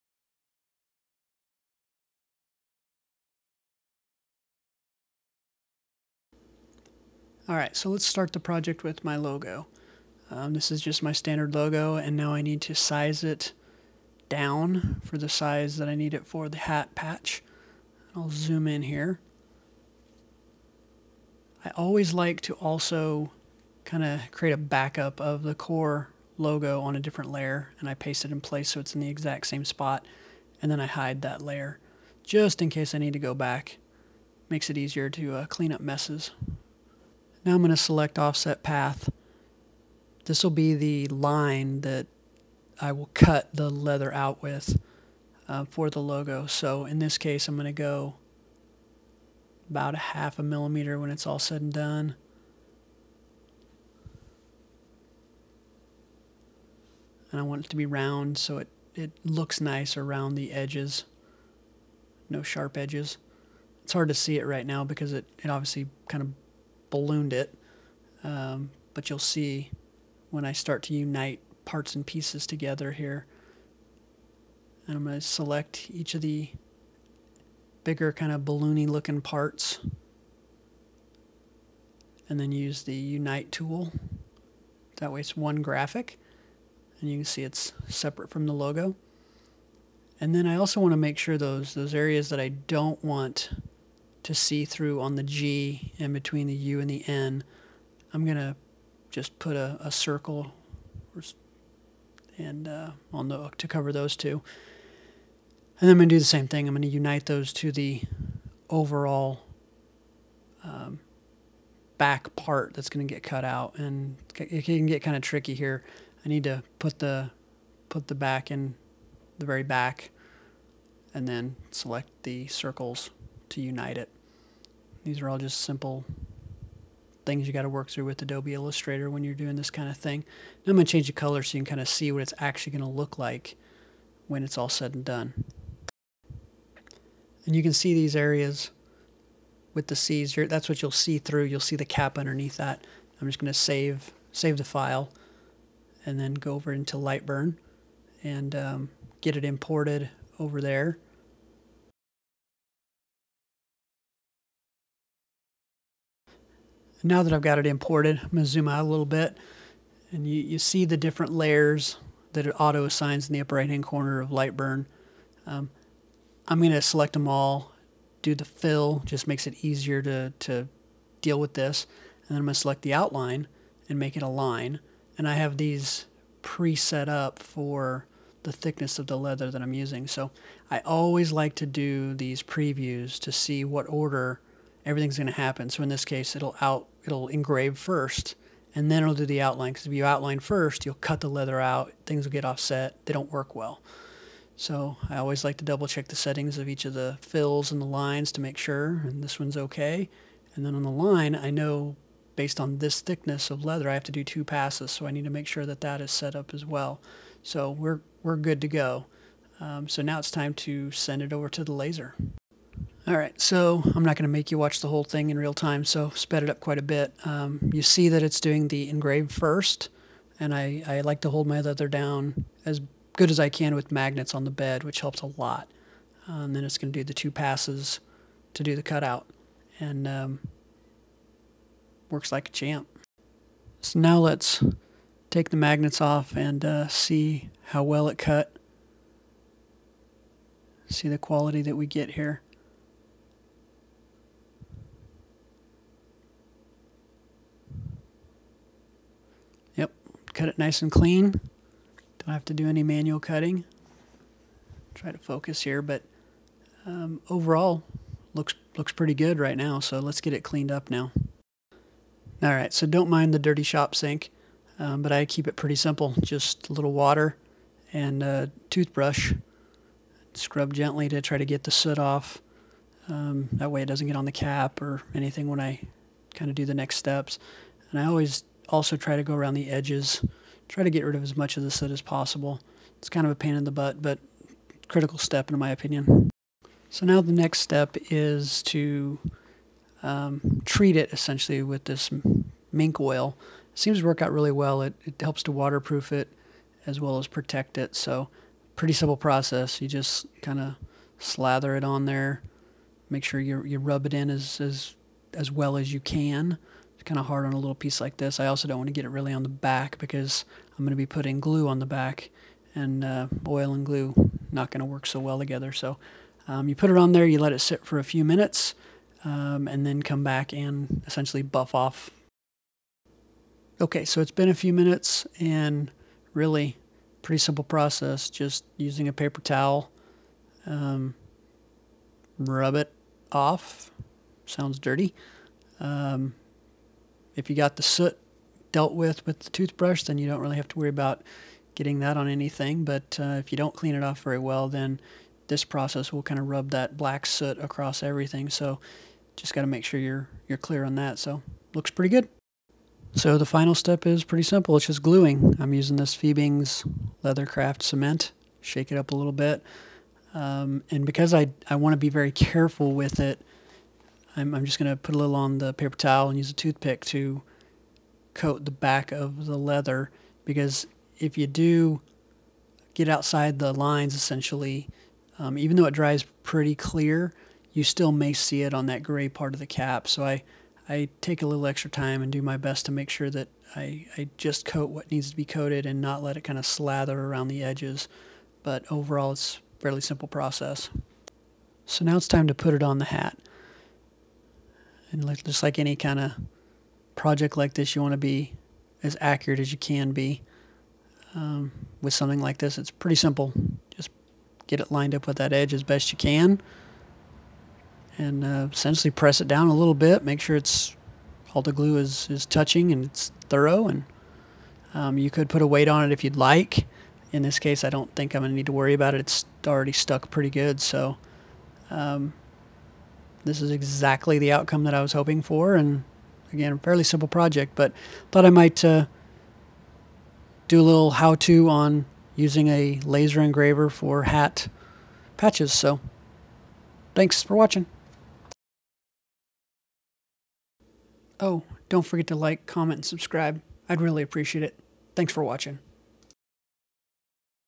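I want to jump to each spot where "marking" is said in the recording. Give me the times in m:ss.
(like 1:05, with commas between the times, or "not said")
not said.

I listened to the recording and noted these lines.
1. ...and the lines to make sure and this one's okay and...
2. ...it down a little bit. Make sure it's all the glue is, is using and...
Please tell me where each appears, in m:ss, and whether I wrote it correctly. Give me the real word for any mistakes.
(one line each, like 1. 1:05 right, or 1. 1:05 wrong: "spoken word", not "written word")
1. 3:17 right
2. 6:49 wrong: "touching", not "using".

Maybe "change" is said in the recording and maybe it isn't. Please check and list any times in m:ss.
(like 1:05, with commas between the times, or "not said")
2:10.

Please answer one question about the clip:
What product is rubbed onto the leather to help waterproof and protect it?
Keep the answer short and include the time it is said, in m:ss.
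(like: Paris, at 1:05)
mink oil, at 4:52.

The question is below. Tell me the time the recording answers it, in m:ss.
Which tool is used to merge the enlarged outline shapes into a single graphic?
1:22.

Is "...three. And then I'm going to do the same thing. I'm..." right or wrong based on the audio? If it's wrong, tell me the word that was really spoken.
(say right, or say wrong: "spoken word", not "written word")
wrong: "two", not "three".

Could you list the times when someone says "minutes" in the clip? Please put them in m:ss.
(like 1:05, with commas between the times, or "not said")
5:18, 5:24.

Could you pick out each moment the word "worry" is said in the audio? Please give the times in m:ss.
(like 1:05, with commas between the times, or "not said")
5:40, 6:58.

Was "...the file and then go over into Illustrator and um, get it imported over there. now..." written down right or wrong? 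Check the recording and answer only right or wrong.
wrong.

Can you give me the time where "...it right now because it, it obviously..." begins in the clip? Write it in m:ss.
1:04.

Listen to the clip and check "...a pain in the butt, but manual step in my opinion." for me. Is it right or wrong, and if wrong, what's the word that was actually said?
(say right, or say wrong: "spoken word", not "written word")
wrong: "critical", not "manual".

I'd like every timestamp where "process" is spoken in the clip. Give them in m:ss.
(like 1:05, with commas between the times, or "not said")
4:59, 5:27, 5:45, 6:30.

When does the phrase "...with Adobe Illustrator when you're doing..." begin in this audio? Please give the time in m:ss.
2:08.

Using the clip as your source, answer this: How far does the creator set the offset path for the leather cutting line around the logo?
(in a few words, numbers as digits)
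half a millimeter.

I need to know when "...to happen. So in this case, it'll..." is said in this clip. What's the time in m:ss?
3:05.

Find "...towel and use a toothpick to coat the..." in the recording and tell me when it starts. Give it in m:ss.
6:05.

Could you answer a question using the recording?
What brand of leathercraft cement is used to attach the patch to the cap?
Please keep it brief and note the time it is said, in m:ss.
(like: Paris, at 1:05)
Fiebing's, at 5:56.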